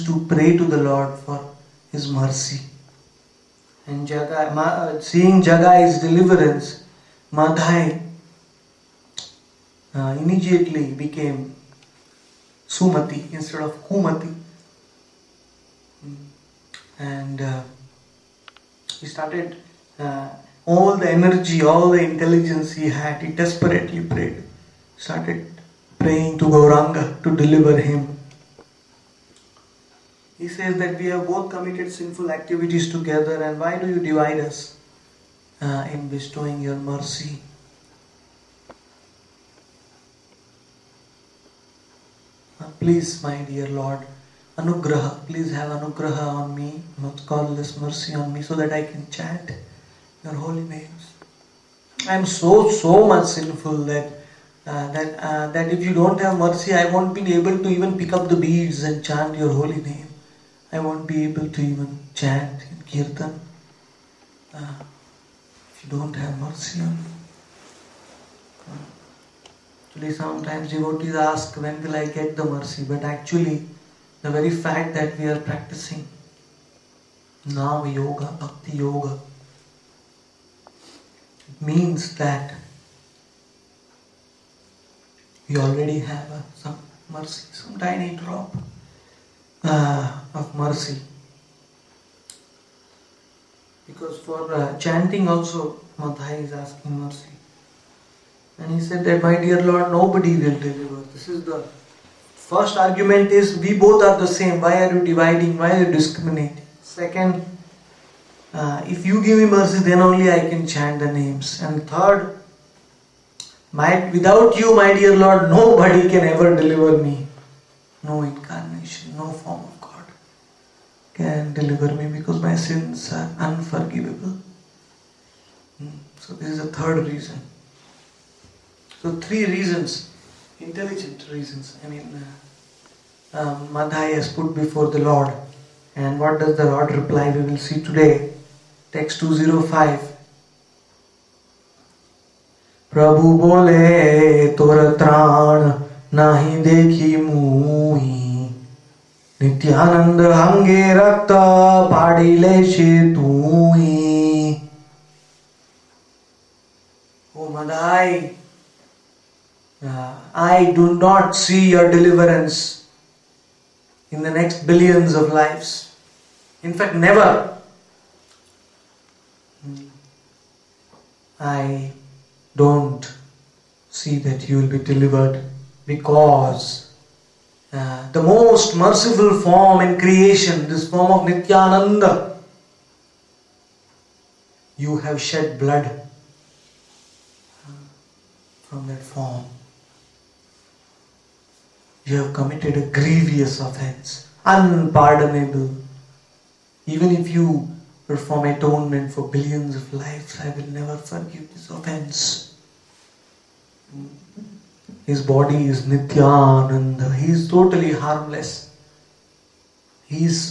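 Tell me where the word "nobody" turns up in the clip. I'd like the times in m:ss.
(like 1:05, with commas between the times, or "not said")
1:39, 1:55.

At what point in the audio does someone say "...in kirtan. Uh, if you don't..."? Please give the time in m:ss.
1:02.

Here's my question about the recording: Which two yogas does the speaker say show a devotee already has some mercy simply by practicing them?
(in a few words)
Nam Yoga, Bhakti Yoga.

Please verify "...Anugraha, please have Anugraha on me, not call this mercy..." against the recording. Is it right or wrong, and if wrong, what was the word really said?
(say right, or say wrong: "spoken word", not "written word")
right.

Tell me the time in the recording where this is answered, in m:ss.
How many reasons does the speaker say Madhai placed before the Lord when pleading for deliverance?
2:09.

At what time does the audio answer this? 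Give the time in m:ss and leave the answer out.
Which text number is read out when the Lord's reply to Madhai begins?
2:19.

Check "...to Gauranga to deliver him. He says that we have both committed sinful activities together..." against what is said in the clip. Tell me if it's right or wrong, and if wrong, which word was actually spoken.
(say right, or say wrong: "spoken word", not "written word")
right.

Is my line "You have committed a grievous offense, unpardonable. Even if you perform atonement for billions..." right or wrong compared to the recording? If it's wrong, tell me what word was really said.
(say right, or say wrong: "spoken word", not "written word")
right.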